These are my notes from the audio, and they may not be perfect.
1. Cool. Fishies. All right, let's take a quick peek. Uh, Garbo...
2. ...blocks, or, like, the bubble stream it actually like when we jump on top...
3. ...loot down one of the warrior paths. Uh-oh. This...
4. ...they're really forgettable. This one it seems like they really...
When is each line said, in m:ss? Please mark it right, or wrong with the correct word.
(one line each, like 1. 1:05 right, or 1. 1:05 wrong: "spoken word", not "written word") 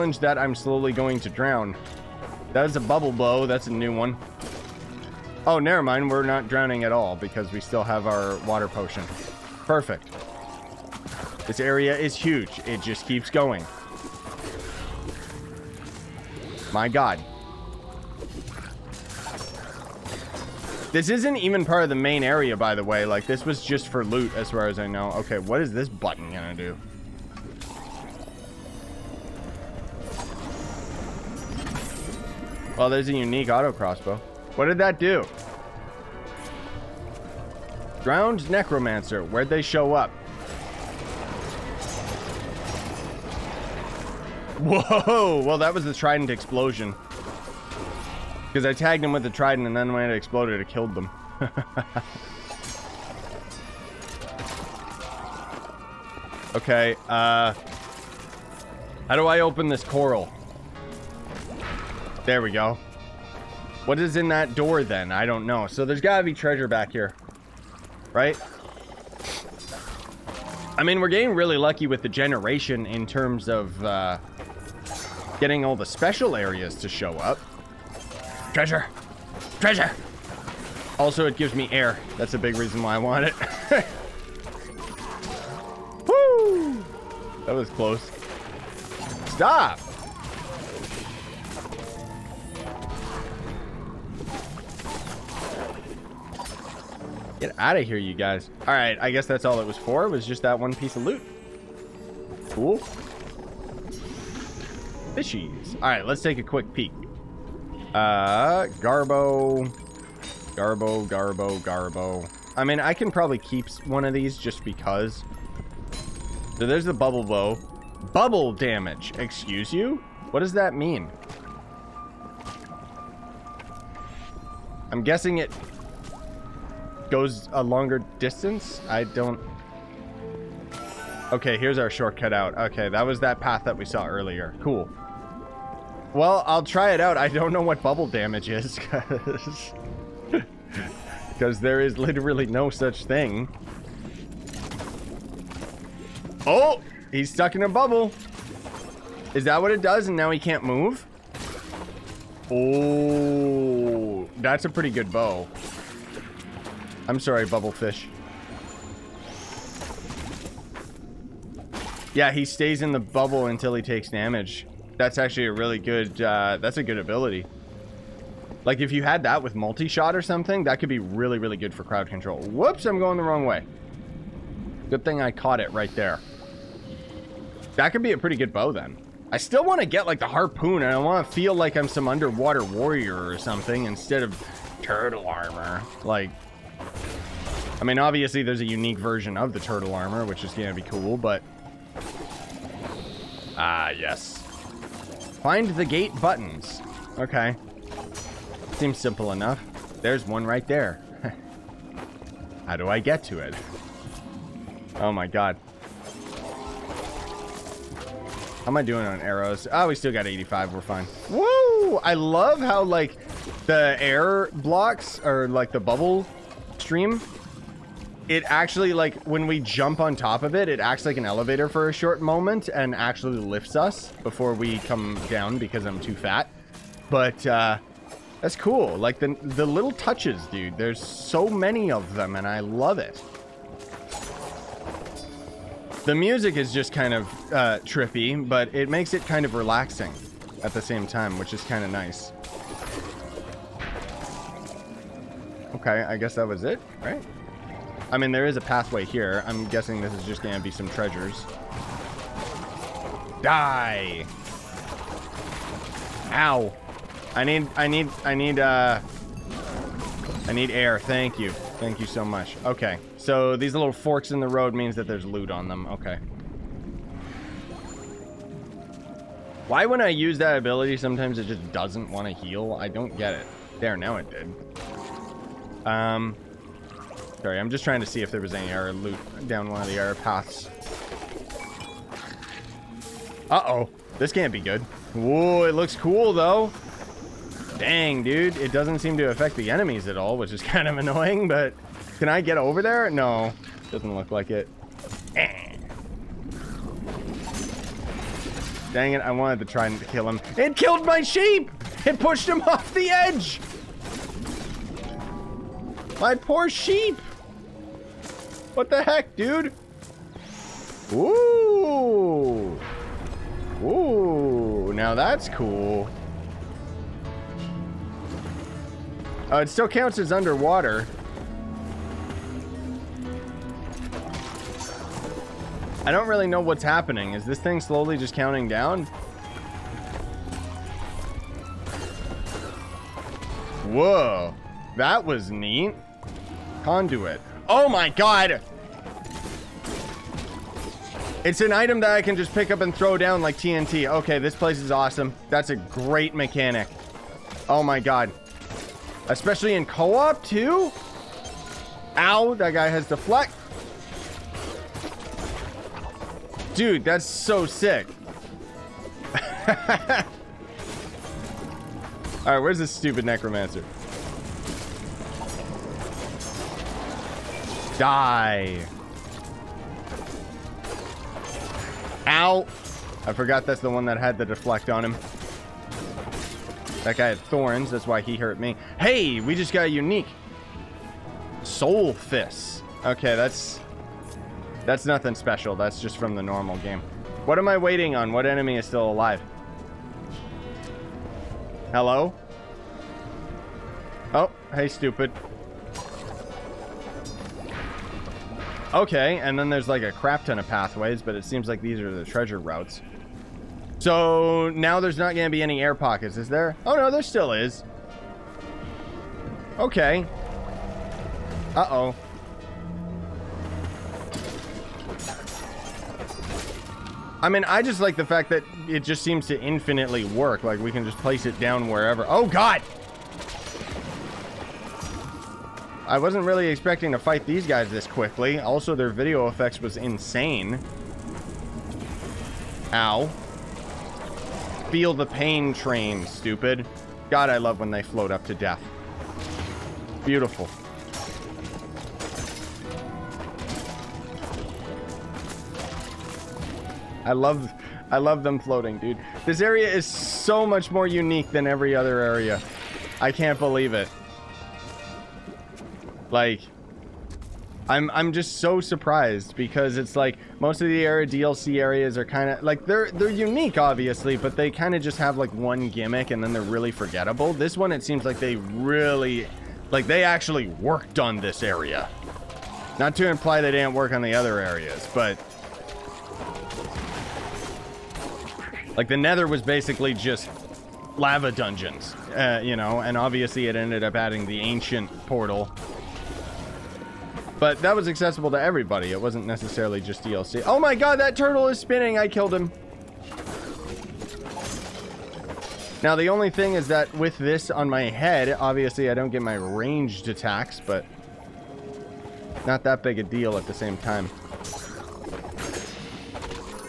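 1. 1:42 right
2. 3:34 right
3. 4:38 wrong: "error", not "warrior"
4. 7:46 right.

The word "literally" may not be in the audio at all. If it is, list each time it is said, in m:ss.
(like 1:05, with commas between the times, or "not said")
2:21.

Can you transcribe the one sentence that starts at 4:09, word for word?
I'm guessing this is just going to be some treasures.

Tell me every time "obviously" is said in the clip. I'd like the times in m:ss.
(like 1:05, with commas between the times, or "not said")
3:07, 7:43, 8:03, 8:18.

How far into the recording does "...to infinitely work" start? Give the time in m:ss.
6:59.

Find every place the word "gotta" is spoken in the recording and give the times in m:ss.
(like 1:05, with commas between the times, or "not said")
1:05.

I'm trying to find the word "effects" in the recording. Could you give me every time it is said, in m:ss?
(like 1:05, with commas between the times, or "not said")
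7:09.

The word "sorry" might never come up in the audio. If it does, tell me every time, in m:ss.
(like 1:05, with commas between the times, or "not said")
2:37, 4:37.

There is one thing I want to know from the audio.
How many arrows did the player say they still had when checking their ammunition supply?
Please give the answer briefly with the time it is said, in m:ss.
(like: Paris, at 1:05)
85, at 3:30.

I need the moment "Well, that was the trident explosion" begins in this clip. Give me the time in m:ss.
0:45.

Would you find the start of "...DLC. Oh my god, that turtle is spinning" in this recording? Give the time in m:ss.
8:10.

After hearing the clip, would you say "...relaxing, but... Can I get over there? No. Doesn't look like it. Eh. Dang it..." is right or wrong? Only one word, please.
wrong.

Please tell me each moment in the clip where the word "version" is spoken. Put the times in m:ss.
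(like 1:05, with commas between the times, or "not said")
3:08.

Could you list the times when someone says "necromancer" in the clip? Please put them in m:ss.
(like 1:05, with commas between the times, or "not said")
0:38, 6:03.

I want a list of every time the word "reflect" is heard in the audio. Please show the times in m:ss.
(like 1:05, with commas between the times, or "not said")
not said.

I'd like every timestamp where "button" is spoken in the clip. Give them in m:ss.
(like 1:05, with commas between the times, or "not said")
0:25, 3:16.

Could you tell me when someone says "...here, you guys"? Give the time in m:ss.
1:37.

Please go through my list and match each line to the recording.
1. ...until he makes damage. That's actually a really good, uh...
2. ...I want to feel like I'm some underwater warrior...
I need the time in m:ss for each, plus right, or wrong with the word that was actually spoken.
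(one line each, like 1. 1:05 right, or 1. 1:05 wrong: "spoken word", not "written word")
1. 2:43 wrong: "takes", not "makes"
2. 3:00 right.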